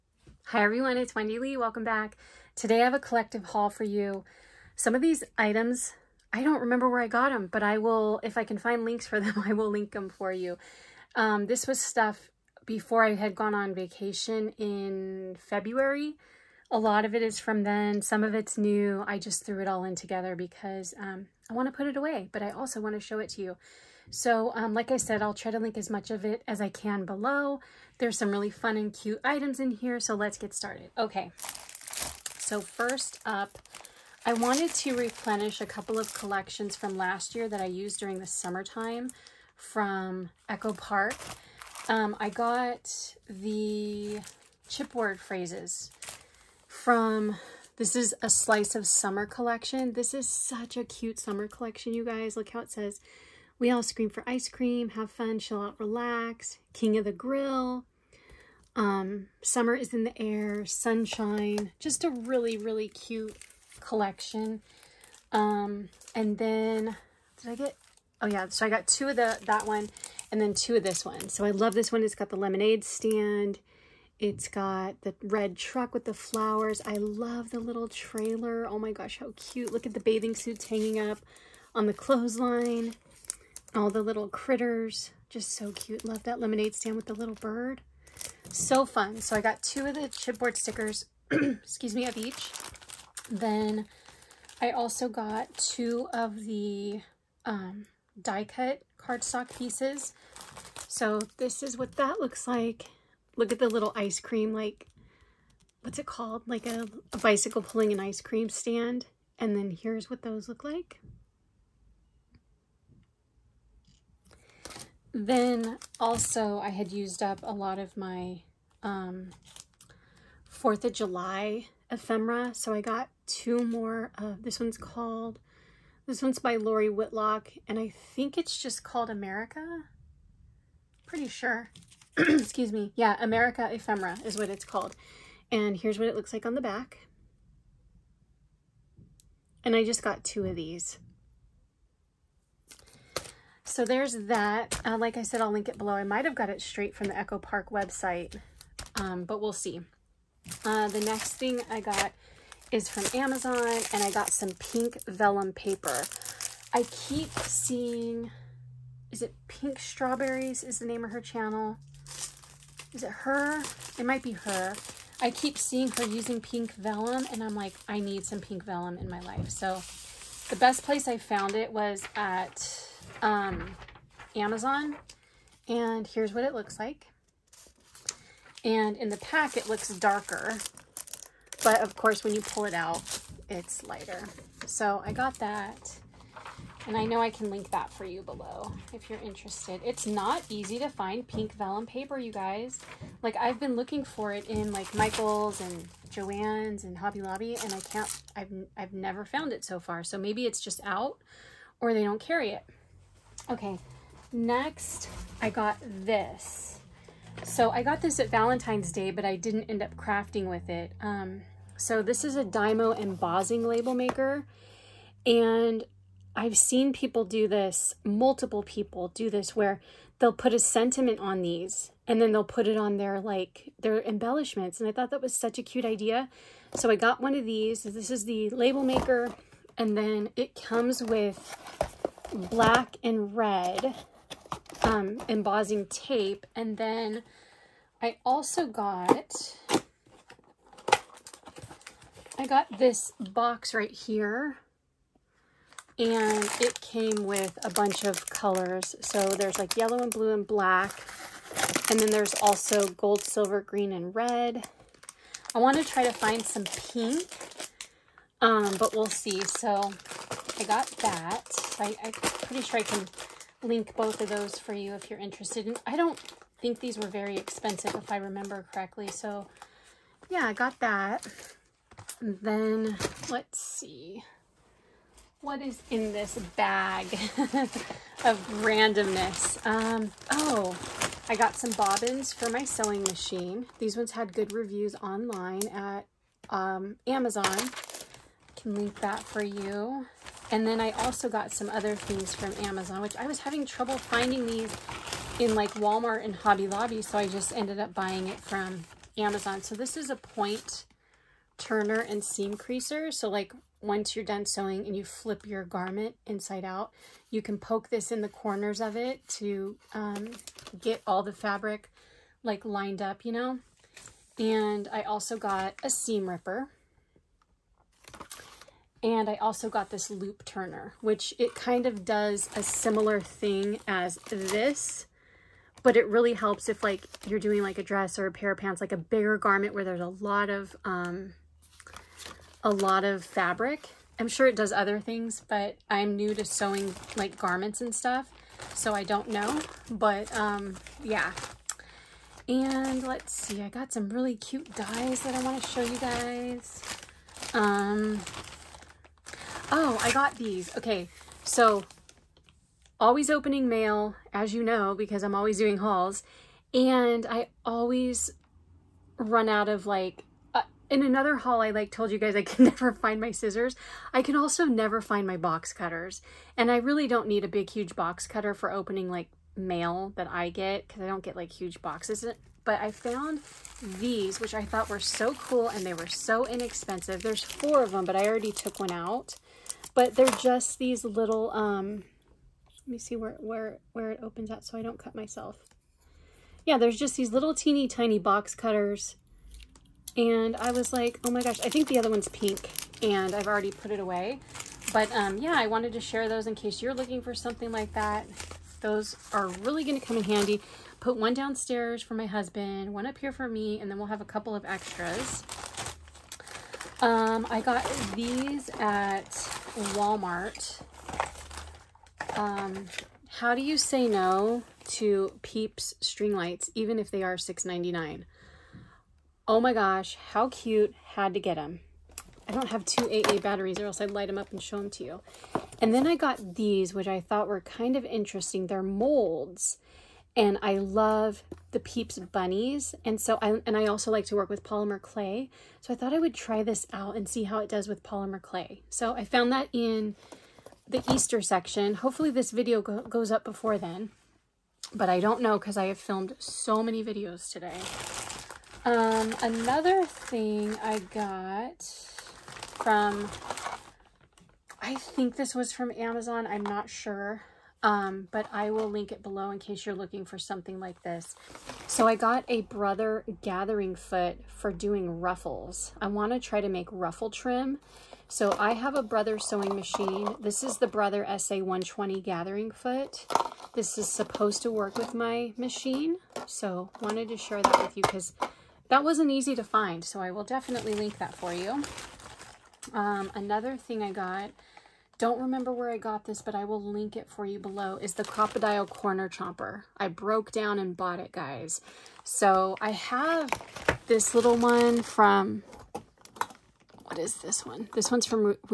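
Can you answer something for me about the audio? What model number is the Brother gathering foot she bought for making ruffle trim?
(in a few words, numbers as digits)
SA120.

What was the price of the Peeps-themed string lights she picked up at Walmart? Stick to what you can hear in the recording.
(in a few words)
$6.99.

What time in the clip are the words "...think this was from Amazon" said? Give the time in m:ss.
7:34.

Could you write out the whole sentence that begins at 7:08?
They're molds and I love the Peeps bunnies.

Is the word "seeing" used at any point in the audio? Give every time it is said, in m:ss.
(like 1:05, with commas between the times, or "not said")
2:37, 2:45.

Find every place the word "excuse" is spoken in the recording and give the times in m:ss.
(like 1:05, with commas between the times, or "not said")
1:31, 2:12.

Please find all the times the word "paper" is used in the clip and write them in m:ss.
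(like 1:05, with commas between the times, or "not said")
2:35, 3:11.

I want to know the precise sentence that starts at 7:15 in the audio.
So I thought I would try this out and see how it does with polymer clay.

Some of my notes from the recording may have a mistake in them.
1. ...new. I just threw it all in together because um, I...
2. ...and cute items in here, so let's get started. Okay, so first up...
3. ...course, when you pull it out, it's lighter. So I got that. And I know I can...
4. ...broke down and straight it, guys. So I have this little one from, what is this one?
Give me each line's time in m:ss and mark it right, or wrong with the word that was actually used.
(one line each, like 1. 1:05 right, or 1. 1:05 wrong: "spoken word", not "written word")
1. 0:18 right
2. 0:28 right
3. 3:01 right
4. 8:10 wrong: "bought", not "straight".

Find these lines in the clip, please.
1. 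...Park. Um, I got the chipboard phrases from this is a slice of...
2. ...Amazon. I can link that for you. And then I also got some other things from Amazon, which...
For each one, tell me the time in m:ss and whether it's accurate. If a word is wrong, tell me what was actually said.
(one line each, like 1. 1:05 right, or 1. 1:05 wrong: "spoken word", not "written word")
1. 0:40 right
2. 4:47 right.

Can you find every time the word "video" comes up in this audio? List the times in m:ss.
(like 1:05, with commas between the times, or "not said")
7:22, 7:27.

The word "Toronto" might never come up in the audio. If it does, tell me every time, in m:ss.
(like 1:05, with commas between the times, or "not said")
not said.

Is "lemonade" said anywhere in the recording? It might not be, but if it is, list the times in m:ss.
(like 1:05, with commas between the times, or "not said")
1:12, 1:26.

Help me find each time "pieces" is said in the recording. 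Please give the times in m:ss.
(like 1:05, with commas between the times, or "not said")
1:39.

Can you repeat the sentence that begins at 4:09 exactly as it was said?
So there's like yellow and blue and black.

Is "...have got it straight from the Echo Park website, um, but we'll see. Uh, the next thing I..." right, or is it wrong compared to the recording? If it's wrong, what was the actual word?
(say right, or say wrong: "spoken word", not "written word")
right.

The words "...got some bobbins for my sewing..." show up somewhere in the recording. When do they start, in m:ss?
4:41.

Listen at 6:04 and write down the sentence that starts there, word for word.
I can also never find my box cutters.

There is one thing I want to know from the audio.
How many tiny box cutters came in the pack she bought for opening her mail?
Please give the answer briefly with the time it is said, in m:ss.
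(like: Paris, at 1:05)
4, at 6:17.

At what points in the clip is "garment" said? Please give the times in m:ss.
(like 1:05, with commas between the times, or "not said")
5:05, 5:29, 5:37.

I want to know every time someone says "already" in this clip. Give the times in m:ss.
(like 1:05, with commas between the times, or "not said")
6:18, 6:33.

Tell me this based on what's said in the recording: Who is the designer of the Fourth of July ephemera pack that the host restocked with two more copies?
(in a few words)
Lori Whitlock.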